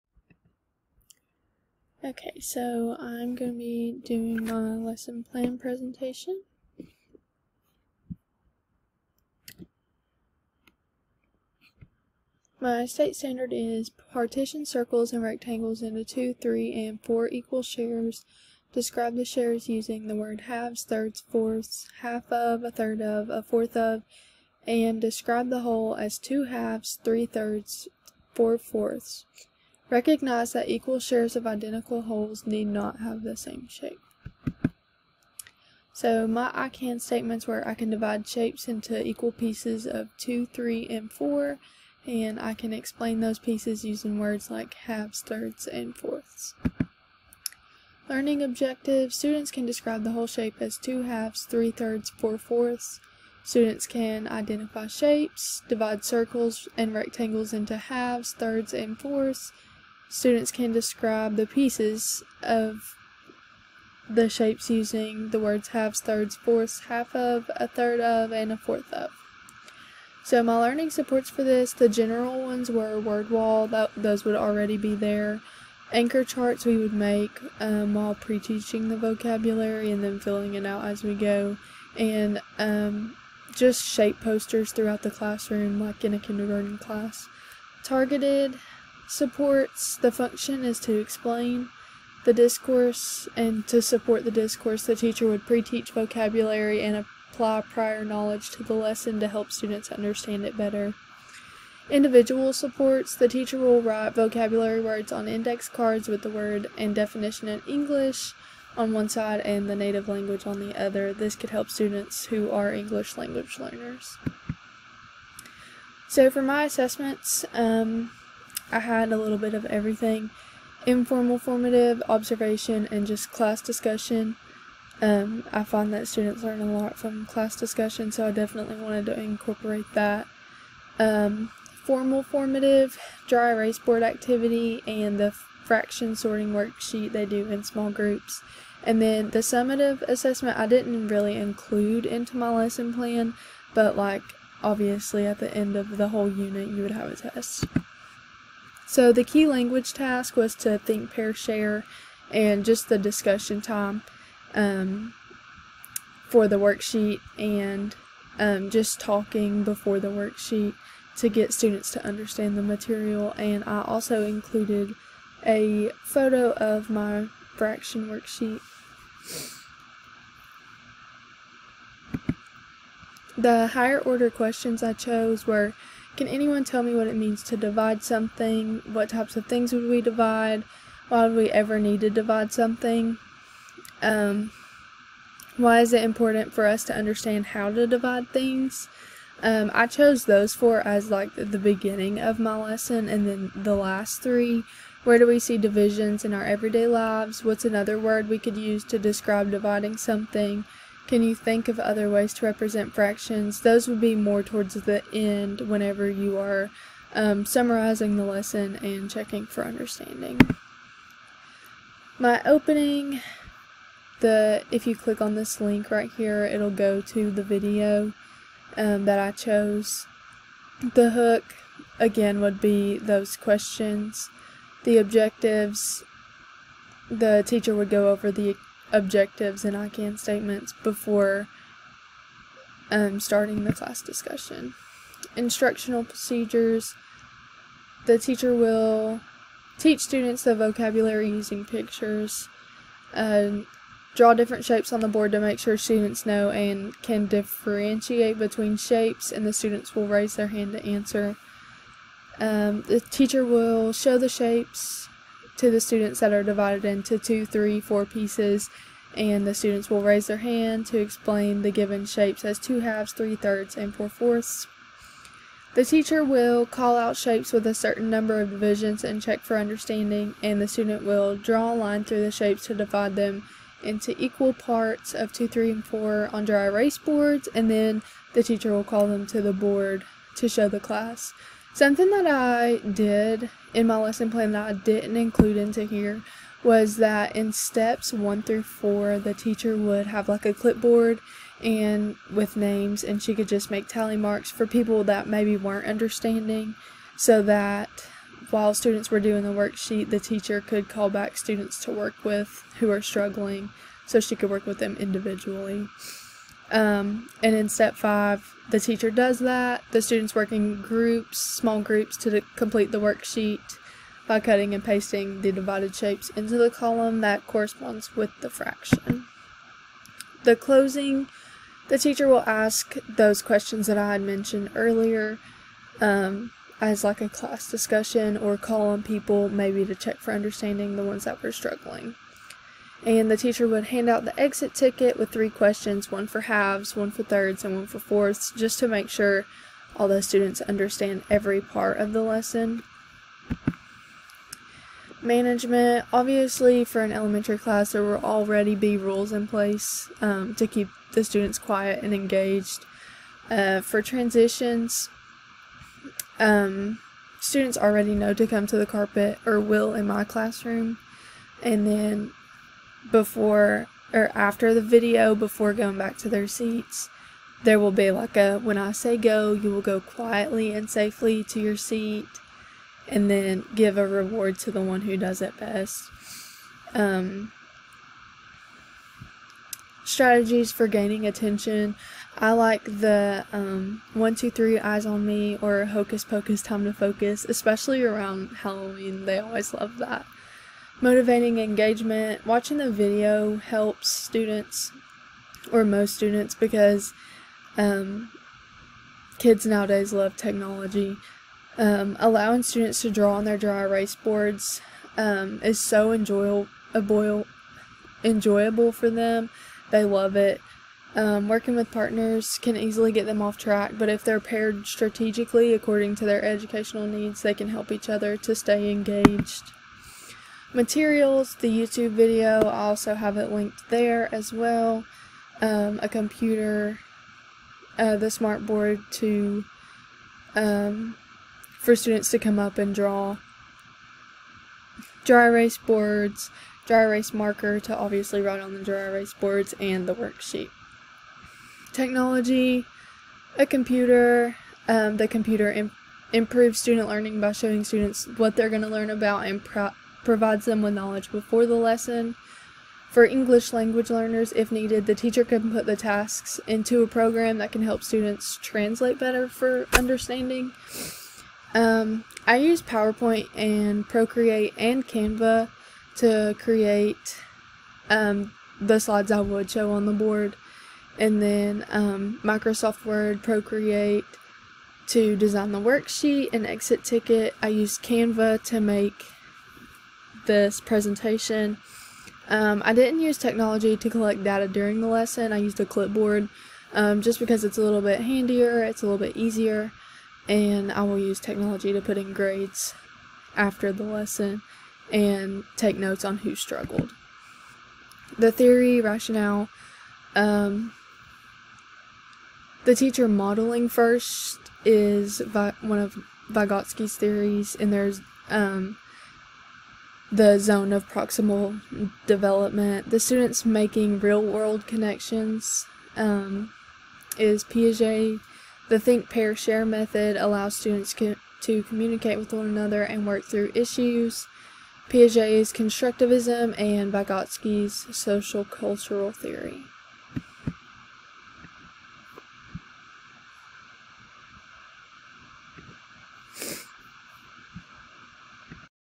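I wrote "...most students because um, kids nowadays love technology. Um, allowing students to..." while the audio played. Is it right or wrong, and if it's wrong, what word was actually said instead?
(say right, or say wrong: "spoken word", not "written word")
right.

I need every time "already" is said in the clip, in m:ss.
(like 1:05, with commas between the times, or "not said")
1:14, 5:48, 5:57.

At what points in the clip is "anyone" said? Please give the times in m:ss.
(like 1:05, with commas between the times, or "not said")
2:56.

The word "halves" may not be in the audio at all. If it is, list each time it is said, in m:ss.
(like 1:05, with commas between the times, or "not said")
0:20, 0:26, 0:44, 0:51, 0:57, 1:05, 4:22, 5:36.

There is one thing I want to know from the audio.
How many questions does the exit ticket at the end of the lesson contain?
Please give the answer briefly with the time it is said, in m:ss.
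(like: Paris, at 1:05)
3, at 5:35.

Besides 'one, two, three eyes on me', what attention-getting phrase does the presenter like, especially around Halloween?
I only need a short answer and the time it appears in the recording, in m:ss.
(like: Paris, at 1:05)
hocus pocus time to focus, at 6:25.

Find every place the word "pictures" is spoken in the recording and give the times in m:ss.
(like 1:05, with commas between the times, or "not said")
4:01.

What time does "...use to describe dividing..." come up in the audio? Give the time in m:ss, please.
3:18.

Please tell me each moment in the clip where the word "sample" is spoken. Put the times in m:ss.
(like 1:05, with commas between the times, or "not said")
not said.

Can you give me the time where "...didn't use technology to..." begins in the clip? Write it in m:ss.
8:02.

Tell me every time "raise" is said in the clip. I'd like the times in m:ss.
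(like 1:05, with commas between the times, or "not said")
4:10, 4:20.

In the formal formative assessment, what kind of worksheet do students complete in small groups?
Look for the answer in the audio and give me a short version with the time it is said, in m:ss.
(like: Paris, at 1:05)
fraction sorting worksheet, at 2:15.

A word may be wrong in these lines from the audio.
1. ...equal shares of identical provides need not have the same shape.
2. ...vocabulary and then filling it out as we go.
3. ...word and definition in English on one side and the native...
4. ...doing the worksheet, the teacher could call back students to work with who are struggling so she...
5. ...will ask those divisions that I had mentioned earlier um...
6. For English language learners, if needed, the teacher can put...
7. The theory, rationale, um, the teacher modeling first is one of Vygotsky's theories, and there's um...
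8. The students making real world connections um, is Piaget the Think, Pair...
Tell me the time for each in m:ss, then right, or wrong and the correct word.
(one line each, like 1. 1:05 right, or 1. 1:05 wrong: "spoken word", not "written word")
1. 0:30 wrong: "wholes", not "provides"
2. 1:18 right
3. 1:46 right
4. 4:59 right
5. 5:22 wrong: "questions", not "divisions"
6. 7:33 right
7. 8:18 right
8. 8:33 right.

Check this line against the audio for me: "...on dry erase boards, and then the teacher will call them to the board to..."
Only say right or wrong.
right.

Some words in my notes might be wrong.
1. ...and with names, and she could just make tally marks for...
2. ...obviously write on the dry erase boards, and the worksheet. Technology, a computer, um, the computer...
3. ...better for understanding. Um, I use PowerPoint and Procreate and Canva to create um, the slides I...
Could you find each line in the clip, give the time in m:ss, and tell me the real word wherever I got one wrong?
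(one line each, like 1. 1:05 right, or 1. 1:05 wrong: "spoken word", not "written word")
1. 4:51 right
2. 7:17 right
3. 7:39 right.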